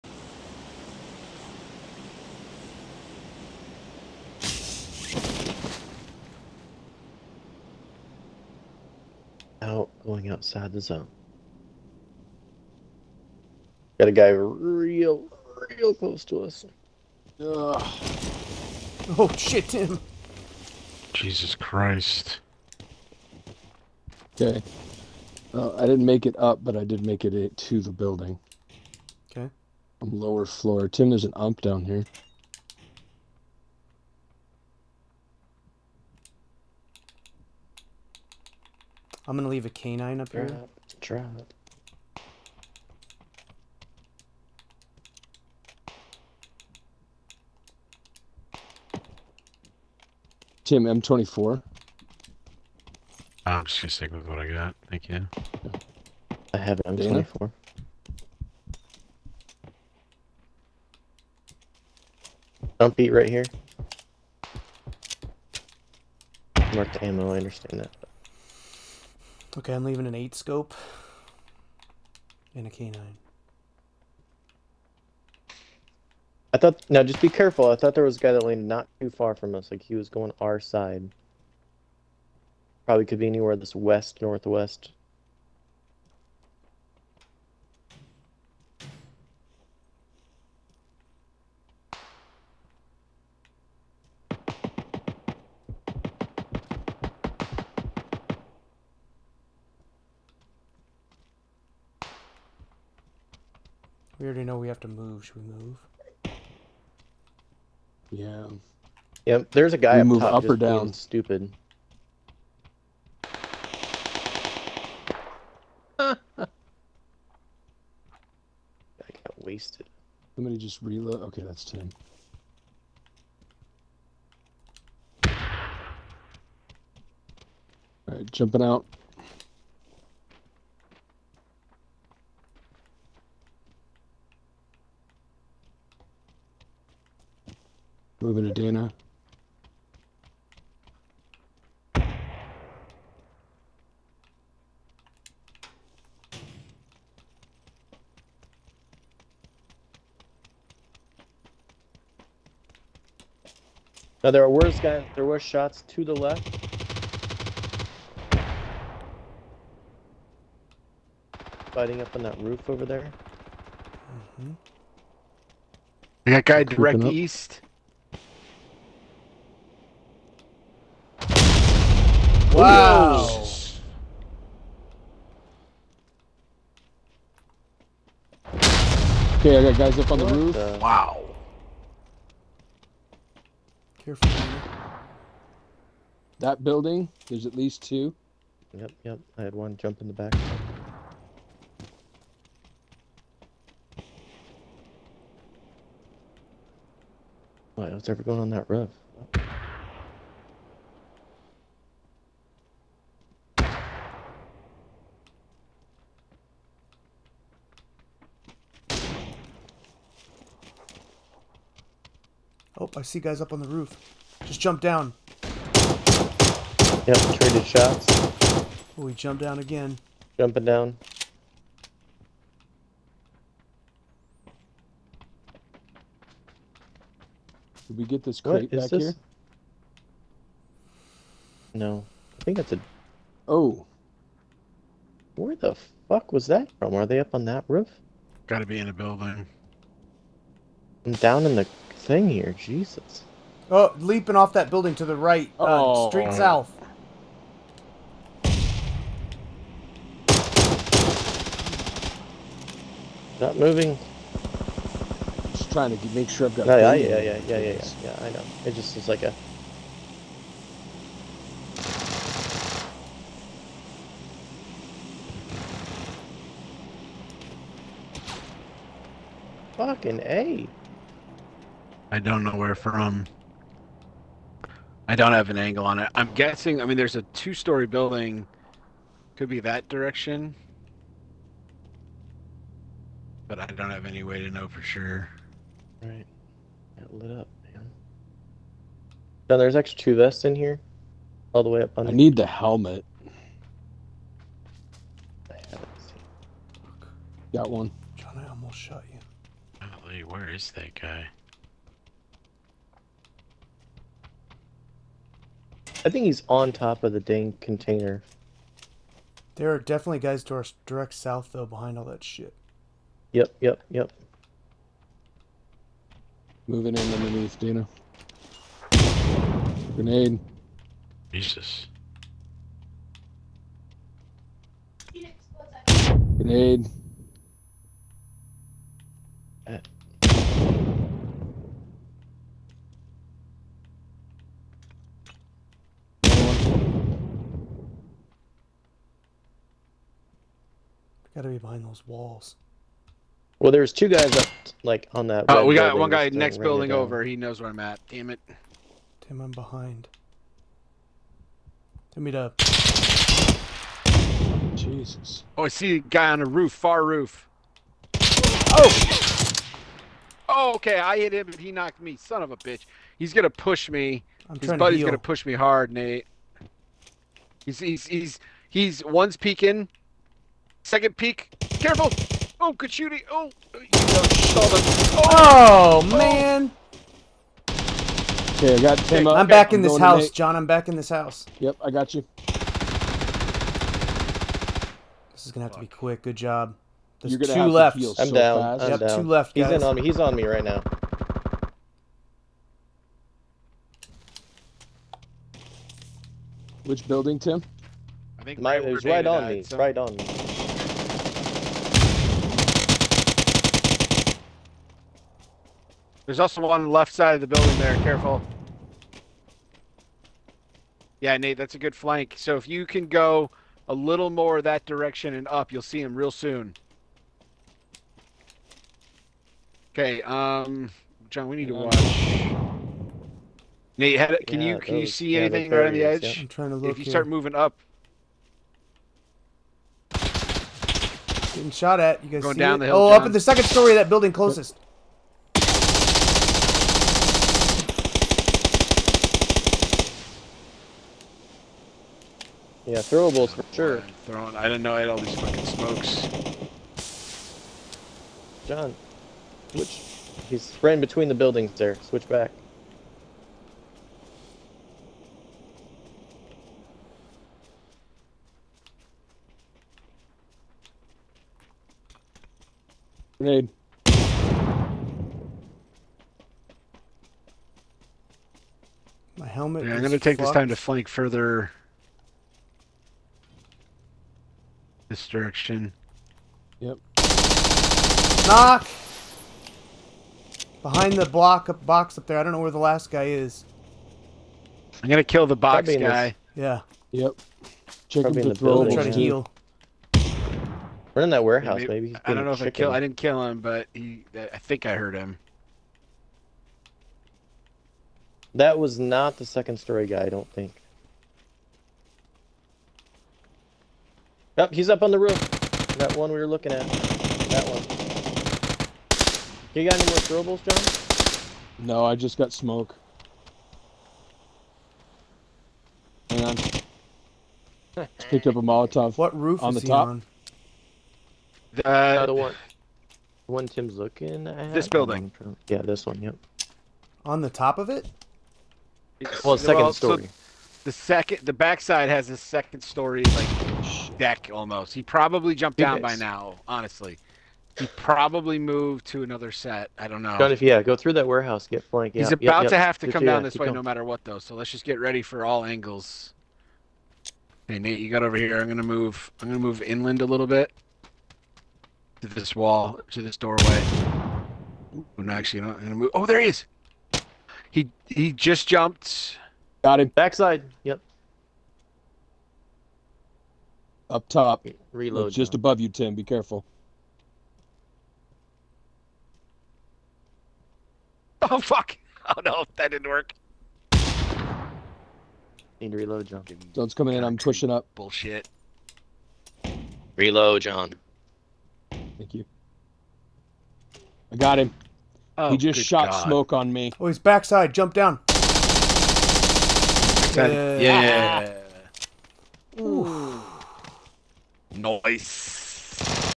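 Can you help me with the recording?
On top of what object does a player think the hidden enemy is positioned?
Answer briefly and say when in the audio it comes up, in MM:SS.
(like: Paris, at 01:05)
Container, at 05:07.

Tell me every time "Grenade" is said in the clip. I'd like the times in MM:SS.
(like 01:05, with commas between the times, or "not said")
05:19, 05:26, 07:43.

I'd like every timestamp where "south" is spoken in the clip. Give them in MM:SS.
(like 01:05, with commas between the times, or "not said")
04:06, 05:11.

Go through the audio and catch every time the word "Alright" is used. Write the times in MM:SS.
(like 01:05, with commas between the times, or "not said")
02:08.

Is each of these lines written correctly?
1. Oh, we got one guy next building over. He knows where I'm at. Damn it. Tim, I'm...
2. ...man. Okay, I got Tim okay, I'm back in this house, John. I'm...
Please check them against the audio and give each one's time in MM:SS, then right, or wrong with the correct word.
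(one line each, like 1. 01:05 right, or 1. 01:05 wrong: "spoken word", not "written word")
1. 05:45 right
2. 06:16 right.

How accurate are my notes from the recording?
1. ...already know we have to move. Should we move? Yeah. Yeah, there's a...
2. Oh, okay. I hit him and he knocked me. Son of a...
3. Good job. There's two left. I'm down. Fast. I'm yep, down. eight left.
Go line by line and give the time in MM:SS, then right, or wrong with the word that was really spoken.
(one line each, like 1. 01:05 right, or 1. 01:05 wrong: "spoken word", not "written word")
1. 01:44 right
2. 06:00 right
3. 06:26 wrong: "two", not "eight".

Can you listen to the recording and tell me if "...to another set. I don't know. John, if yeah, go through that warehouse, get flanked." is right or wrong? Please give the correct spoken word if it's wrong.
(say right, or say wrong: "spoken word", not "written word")
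right.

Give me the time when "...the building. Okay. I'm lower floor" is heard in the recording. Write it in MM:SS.
00:27.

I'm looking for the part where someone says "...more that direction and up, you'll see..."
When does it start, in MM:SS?
06:54.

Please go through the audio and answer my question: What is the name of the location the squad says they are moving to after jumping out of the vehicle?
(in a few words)
Dana.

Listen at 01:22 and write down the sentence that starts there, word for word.
Probably could be anywhere this west, northwest.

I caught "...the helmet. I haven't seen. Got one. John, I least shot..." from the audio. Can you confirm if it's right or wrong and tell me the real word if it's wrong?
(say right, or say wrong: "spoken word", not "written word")
wrong: "almost", not "least".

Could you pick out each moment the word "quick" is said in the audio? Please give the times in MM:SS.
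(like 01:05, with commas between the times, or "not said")
06:25.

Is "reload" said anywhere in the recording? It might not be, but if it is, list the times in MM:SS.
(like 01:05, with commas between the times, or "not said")
02:00, 09:24, 09:35, 09:40.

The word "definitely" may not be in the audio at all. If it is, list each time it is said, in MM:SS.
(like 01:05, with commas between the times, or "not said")
05:09.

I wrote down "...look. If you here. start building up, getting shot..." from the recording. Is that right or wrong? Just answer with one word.
wrong.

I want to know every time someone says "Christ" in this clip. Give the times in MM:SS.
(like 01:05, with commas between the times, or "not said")
00:21.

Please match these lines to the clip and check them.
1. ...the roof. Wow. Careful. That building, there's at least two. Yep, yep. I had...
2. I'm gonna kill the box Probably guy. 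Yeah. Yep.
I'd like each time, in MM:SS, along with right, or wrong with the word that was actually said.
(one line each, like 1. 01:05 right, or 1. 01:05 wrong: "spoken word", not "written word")
1. 03:00 right
2. 08:05 right.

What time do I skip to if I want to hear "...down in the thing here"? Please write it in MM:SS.
04:01.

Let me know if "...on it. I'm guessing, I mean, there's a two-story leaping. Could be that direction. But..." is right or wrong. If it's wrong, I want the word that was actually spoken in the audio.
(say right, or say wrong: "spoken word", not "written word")
wrong: "building", not "leaping".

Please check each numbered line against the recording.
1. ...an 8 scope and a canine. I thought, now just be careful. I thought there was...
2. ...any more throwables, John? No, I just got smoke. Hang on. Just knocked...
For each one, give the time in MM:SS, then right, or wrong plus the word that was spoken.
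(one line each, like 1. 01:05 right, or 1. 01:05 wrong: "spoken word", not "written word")
1. 01:10 right
2. 08:29 wrong: "picked", not "knocked".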